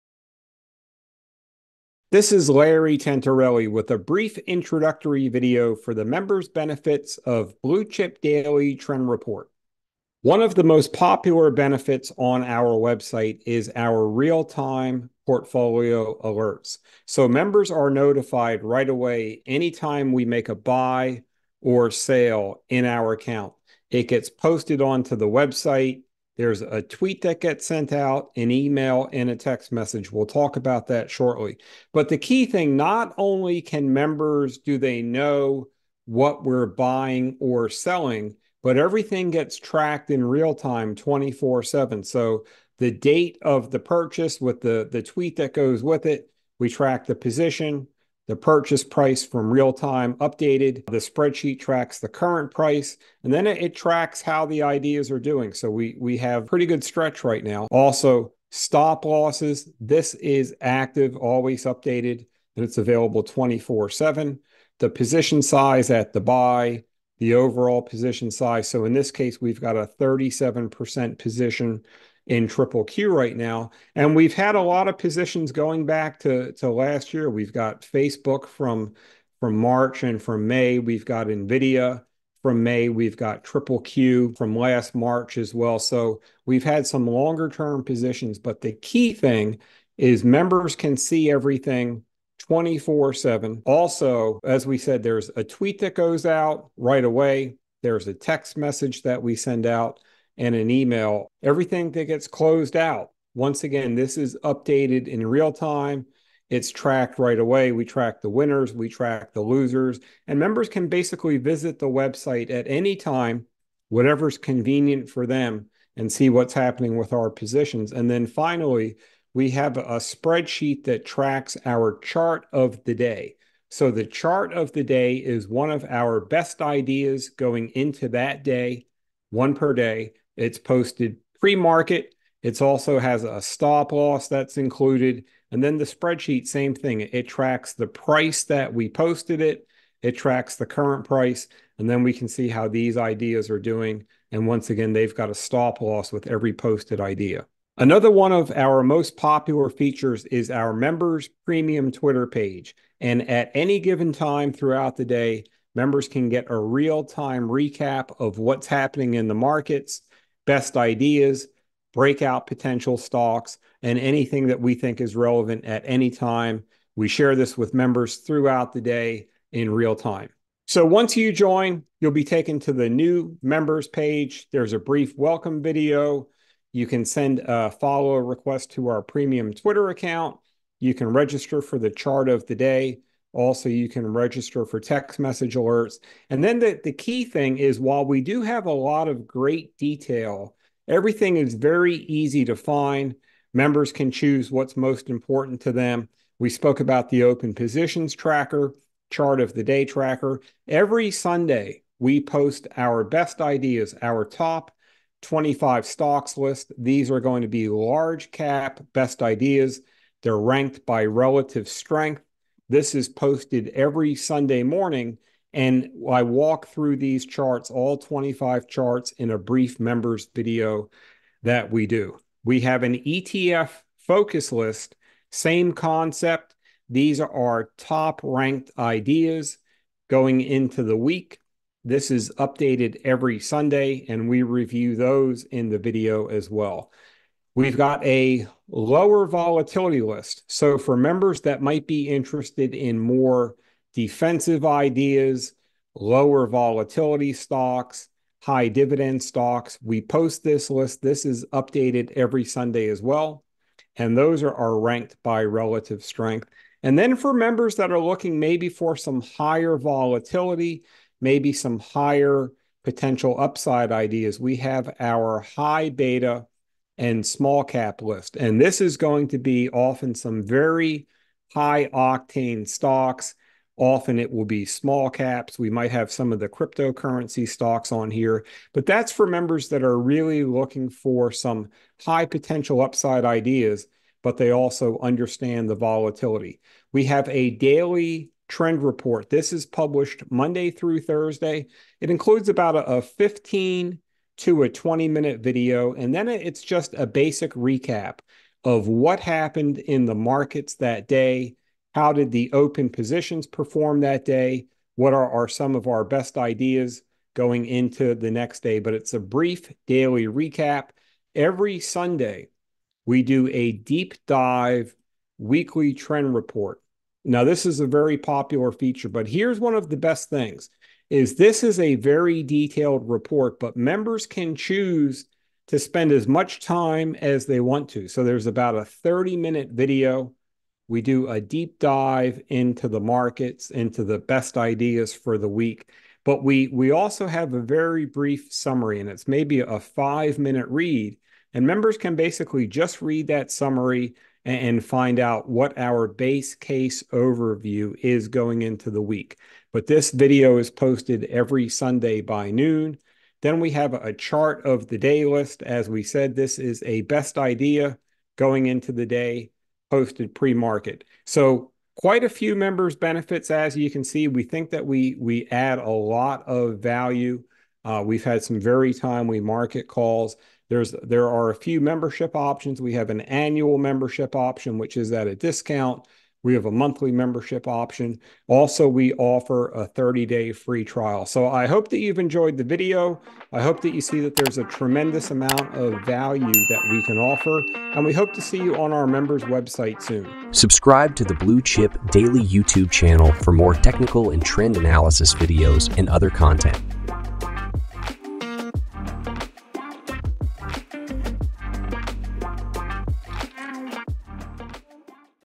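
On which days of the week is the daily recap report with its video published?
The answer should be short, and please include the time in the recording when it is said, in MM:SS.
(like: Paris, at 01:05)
Monday through Thursday, at 04:50.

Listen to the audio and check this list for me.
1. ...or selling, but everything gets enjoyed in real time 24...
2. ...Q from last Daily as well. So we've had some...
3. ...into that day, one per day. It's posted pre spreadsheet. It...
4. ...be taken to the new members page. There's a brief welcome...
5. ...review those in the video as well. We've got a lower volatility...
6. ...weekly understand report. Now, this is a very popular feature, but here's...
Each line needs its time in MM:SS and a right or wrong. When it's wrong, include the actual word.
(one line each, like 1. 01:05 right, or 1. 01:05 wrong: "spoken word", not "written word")
1. 00:37 wrong: "tracked", not "enjoyed"
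2. 01:23 wrong: "March", not "Daily"
3. 02:07 wrong: "market", not "spreadsheet"
4. 02:52 right
5. 03:54 right
6. 05:15 wrong: "trend", not "understand".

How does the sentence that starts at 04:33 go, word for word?
Often it will be small caps.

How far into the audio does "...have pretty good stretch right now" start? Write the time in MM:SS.
00:56.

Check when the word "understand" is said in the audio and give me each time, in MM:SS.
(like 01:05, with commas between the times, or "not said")
04:44.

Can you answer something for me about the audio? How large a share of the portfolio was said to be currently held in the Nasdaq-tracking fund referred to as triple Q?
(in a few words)
37%.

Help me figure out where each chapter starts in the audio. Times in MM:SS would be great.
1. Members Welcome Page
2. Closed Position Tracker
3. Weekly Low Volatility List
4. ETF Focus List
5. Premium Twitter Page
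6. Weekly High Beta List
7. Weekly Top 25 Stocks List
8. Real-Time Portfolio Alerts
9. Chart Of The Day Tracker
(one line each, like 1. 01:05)
1. 02:51
2. 01:42
3. 03:58
4. 03:42
5. 02:28
6. 04:17
7. 03:22
8. 00:30
9. 01:59.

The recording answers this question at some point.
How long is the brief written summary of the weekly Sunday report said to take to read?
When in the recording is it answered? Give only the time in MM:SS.
05:39.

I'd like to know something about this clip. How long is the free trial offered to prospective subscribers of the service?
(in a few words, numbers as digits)
30 days.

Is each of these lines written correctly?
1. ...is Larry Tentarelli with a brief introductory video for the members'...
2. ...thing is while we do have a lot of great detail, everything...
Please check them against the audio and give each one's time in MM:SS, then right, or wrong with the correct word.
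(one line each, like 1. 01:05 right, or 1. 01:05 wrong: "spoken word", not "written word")
1. 00:02 right
2. 03:07 right.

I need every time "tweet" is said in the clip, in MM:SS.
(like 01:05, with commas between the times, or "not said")
00:26, 00:45, 01:35.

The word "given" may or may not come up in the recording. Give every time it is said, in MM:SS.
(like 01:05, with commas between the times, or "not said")
02:33.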